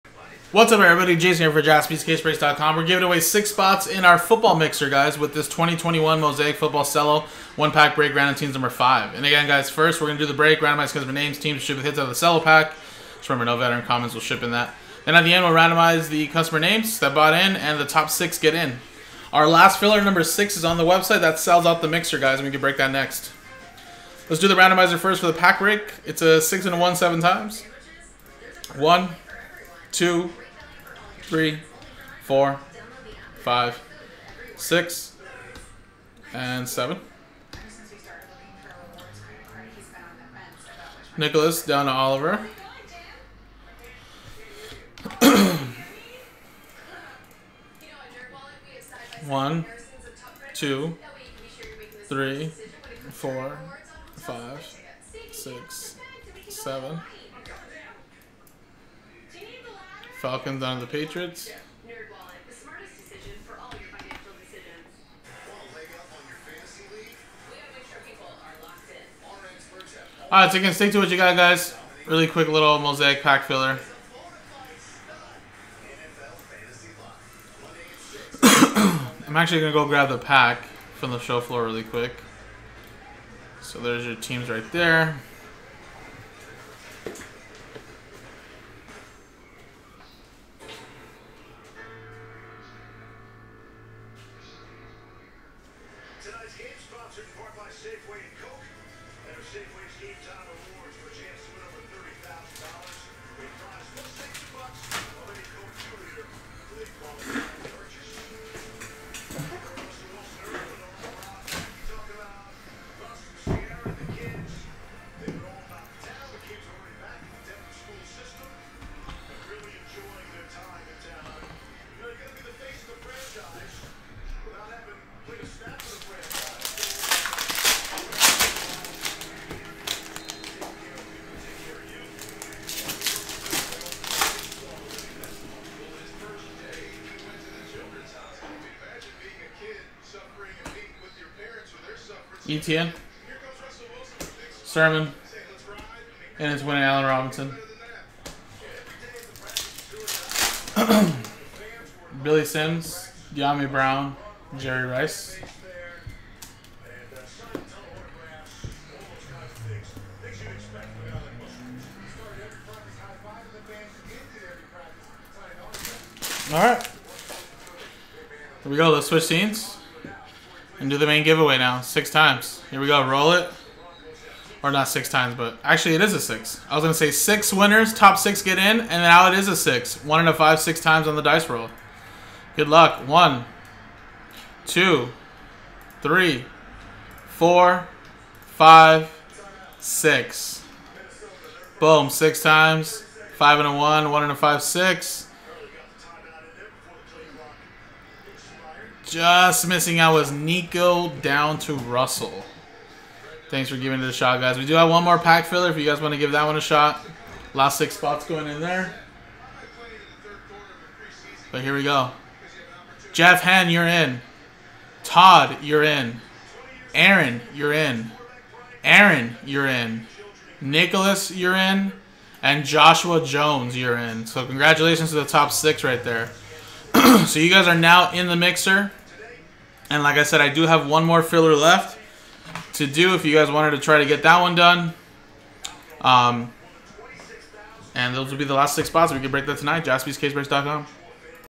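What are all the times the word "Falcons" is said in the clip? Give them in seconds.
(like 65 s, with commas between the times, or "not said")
60 s.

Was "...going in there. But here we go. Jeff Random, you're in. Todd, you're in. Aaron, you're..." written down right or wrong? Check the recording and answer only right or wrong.
wrong.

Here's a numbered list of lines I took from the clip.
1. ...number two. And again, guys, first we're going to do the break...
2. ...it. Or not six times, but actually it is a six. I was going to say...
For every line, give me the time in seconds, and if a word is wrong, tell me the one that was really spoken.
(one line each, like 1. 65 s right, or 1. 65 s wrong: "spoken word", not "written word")
1. 8 s wrong: "five", not "two"
2. 173 s right.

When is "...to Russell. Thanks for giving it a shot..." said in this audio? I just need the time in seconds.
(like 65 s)
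201 s.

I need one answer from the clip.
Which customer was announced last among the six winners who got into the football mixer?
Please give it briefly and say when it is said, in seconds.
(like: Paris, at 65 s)
Joshua Jones, at 222 s.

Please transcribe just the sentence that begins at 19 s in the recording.
Our last filler, number six, is on the website.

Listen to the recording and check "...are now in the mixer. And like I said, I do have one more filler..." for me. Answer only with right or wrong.
right.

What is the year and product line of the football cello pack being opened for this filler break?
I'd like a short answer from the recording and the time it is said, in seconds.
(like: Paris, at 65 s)
2021 Mosaic, at 5 s.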